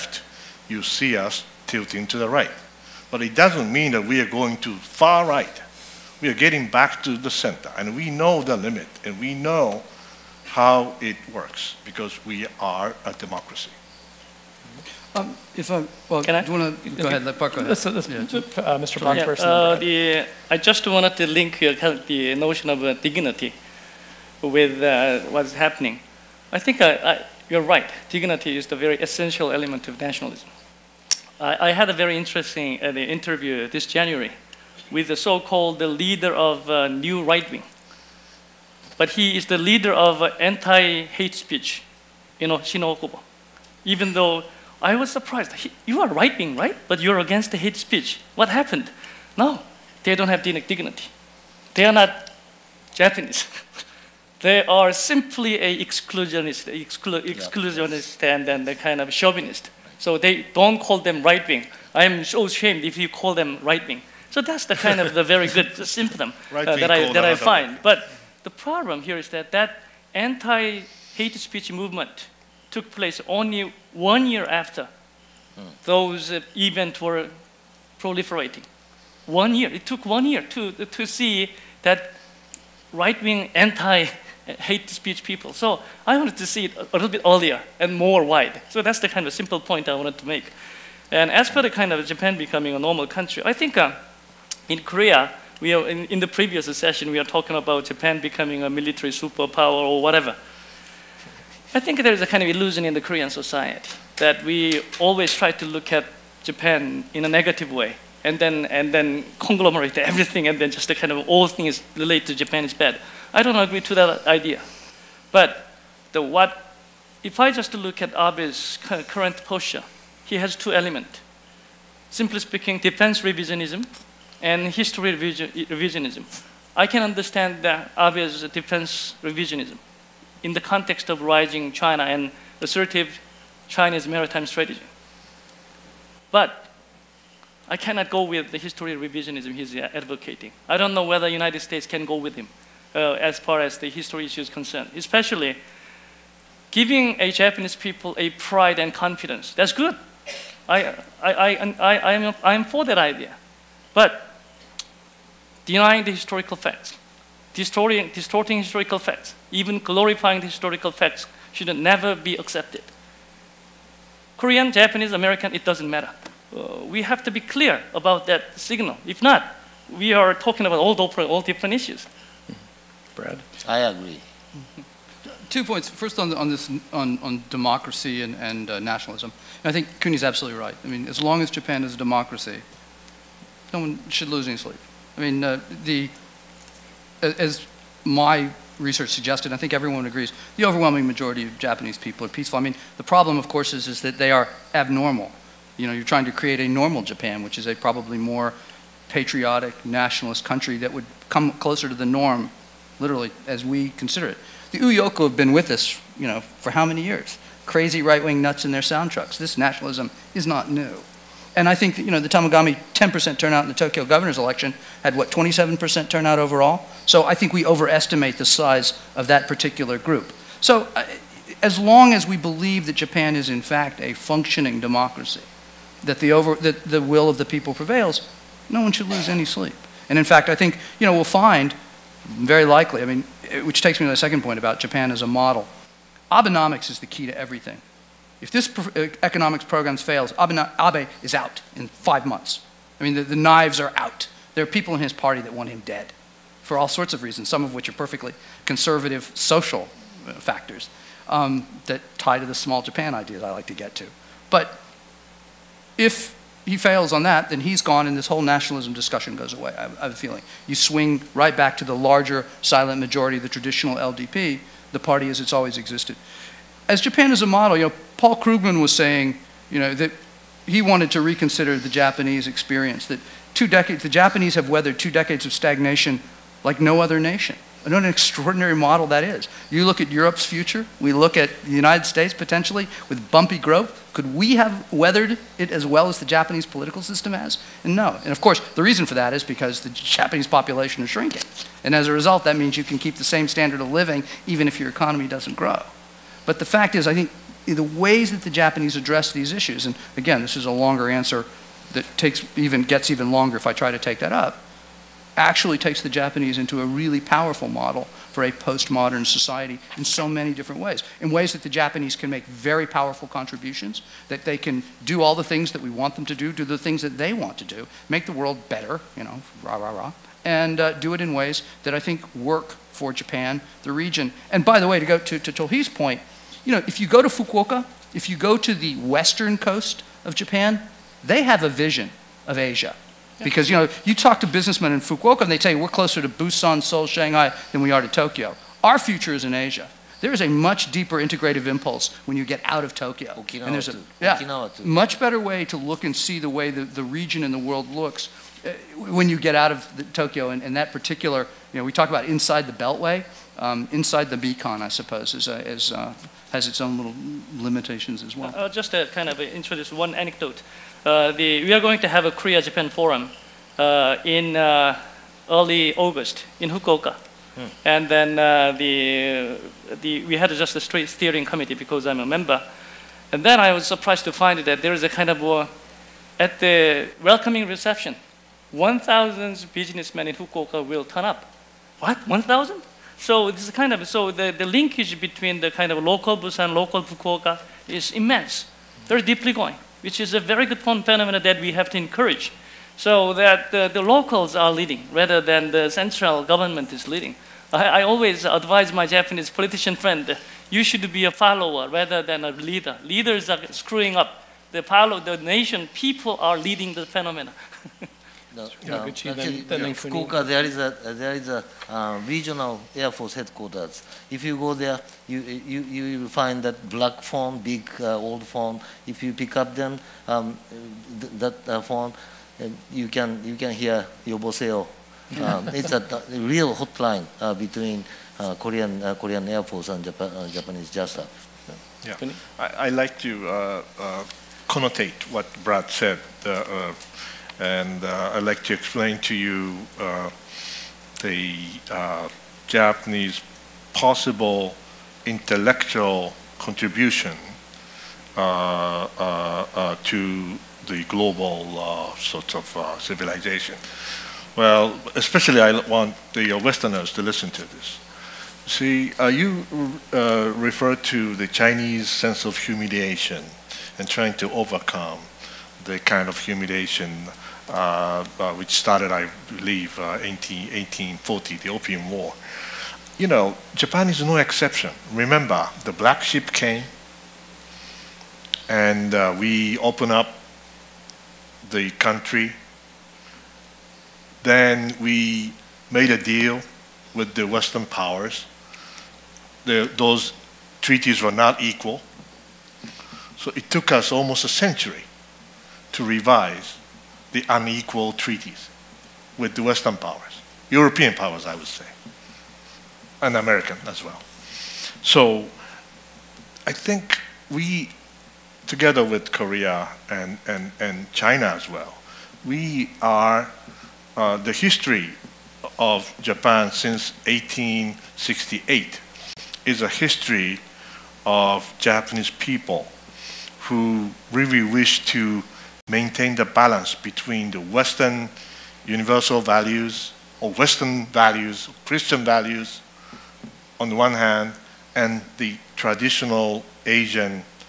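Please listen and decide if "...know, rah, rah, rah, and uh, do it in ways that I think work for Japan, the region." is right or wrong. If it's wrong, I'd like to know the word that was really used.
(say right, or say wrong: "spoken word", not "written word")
right.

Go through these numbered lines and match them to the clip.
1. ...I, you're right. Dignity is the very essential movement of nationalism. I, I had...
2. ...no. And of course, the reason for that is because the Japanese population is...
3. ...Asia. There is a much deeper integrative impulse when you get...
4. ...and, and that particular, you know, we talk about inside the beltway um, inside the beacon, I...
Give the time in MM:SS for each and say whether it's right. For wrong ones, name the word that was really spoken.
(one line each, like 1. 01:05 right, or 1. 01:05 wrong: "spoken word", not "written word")
1. 00:26 wrong: "element", not "movement"
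2. 04:47 right
3. 05:39 right
4. 05:50 right.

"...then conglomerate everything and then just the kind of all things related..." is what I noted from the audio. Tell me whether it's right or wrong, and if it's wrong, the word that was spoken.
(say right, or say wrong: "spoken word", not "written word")
right.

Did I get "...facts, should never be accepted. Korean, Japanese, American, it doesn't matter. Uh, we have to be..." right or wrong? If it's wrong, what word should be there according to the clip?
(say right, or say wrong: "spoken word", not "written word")
right.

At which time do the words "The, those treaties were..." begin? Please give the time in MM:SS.
08:09.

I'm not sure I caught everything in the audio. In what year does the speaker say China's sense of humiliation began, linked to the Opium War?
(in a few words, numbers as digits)
1840.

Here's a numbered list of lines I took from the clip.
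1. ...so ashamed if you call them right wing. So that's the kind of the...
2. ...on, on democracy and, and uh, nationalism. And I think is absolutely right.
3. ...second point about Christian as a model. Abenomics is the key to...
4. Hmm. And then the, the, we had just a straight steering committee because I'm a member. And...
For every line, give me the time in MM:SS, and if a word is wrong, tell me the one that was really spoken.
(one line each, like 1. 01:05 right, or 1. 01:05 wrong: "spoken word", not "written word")
1. 01:02 right
2. 02:56 right
3. 03:54 wrong: "Japan", not "Christian"
4. 06:07 right.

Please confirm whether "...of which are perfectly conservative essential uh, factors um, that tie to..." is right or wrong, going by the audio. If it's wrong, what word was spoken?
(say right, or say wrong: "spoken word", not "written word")
wrong: "social", not "essential".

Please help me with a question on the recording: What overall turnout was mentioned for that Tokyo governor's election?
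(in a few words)
27%.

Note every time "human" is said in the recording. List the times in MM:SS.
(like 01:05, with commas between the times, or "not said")
not said.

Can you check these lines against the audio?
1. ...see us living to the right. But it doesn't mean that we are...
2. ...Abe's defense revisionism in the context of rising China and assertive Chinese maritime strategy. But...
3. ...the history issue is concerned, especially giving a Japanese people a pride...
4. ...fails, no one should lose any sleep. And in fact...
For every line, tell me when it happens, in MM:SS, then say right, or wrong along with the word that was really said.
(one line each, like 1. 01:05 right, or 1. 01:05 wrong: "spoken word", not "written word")
1. 00:00 wrong: "tilting", not "living"
2. 02:07 right
3. 02:23 right
4. 03:47 wrong: "prevails", not "fails".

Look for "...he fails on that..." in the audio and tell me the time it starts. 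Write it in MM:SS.
04:16.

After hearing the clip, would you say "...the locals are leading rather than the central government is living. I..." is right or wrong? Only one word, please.
wrong.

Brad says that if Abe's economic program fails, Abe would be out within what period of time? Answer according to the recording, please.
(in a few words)
Five months.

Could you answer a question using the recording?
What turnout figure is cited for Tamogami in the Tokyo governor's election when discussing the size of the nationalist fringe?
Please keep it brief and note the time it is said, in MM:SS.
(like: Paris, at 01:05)
10%, at 03:32.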